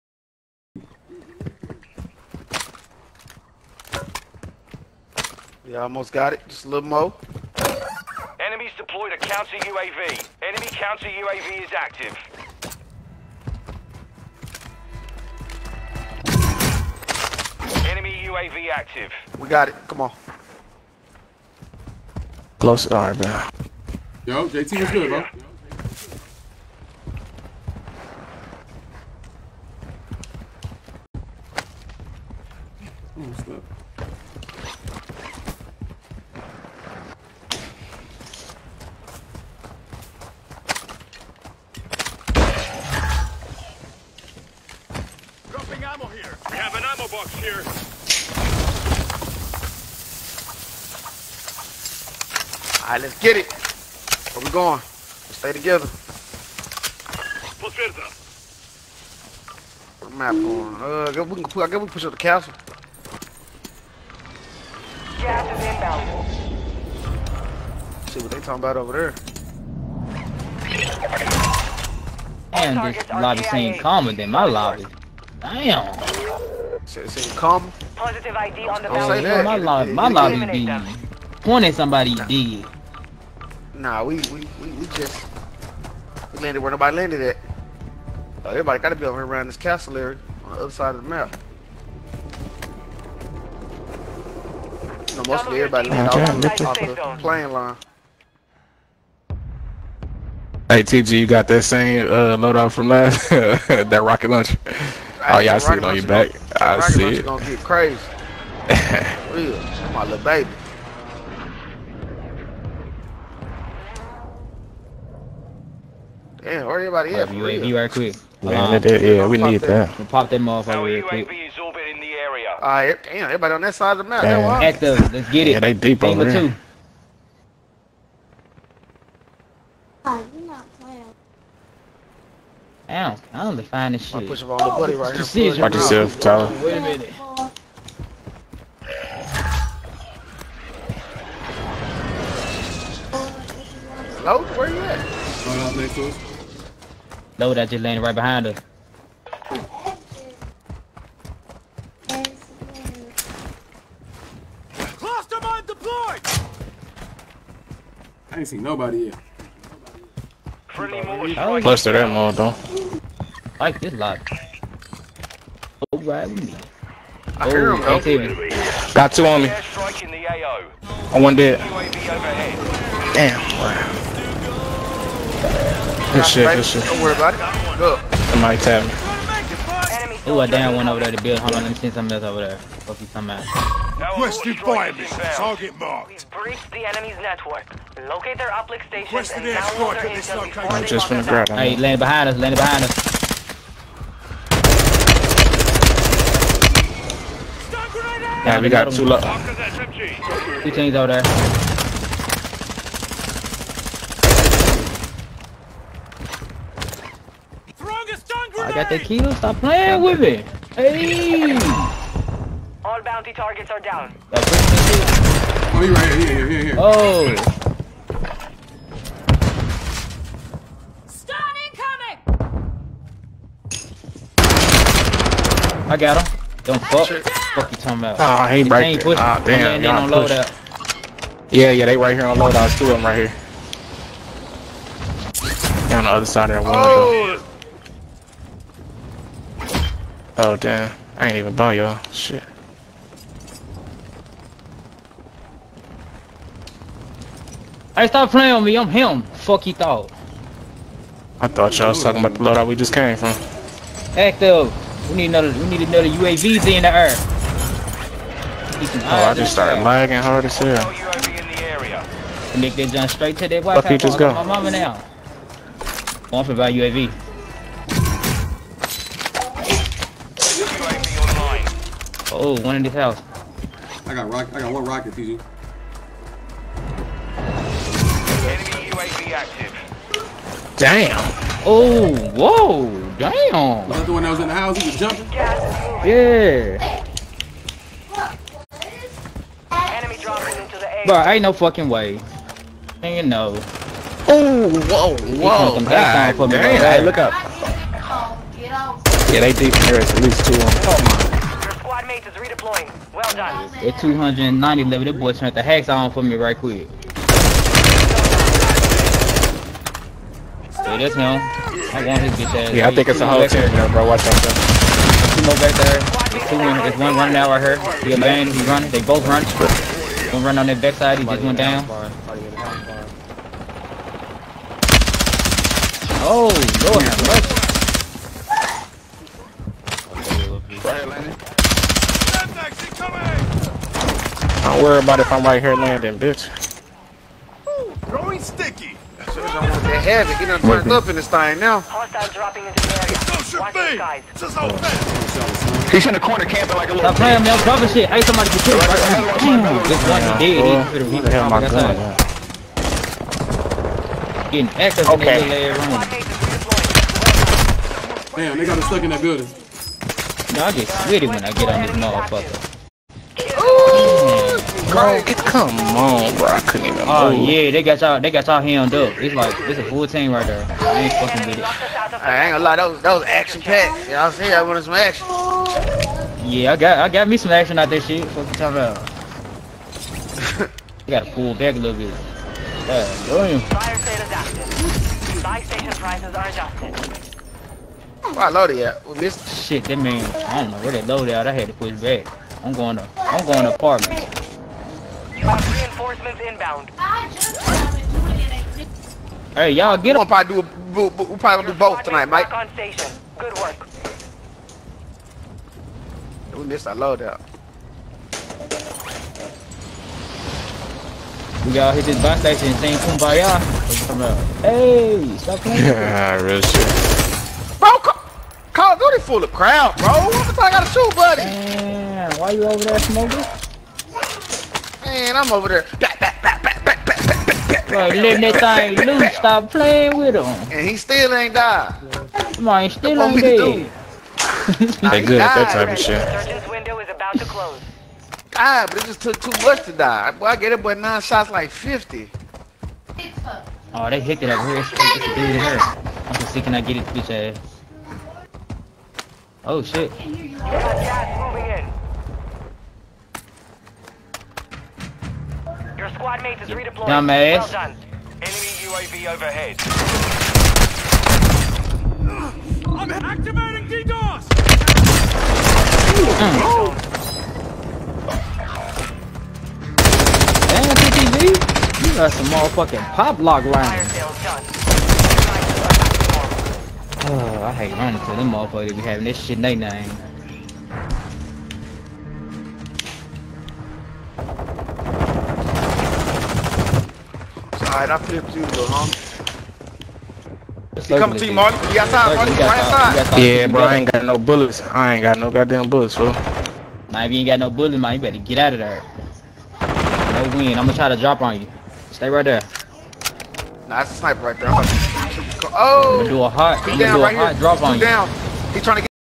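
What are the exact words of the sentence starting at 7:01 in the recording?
Man, why you over there smoking?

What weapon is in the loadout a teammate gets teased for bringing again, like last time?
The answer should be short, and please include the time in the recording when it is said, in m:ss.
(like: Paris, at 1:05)
rocket launcher, at 1:44.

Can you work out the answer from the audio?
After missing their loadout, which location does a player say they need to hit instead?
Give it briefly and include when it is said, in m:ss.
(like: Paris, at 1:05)
box station, at 6:52.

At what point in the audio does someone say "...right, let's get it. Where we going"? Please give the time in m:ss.
0:52.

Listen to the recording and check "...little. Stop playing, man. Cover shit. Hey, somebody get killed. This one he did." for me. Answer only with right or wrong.
right.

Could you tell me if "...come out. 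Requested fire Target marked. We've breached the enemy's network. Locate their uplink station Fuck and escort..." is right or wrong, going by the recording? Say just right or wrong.
wrong.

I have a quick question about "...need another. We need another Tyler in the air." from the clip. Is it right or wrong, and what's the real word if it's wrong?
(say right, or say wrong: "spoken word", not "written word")
wrong: "UAVs", not "Tyler".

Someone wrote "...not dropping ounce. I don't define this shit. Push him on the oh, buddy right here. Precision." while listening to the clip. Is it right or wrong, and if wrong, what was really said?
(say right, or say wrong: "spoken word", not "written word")
wrong: "playing", not "dropping".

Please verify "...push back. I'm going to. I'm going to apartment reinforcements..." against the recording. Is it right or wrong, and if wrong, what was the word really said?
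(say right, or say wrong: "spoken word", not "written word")
right.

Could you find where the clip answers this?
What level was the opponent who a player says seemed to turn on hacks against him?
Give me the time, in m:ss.
5:03.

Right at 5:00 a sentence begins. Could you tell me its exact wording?
It's at least two of them.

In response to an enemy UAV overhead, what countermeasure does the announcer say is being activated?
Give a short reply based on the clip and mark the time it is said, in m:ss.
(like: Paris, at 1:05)
DDoS, at 7:43.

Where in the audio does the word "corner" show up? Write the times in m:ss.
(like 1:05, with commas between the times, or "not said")
5:46.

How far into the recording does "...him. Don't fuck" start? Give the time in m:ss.
3:46.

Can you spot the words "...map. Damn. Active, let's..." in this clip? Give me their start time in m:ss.
2:04.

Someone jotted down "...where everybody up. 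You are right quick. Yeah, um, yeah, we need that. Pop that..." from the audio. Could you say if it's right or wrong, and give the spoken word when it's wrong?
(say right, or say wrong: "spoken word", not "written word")
right.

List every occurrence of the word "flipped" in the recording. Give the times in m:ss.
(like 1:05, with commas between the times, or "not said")
8:08.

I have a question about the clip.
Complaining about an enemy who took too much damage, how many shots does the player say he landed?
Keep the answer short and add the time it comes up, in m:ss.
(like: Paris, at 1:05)
9, at 7:20.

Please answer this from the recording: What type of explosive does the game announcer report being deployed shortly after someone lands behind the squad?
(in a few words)
Cluster mine.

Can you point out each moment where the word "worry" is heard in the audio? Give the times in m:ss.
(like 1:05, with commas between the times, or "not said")
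2:57, 5:34.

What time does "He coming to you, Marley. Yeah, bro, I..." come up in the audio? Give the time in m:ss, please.
8:11.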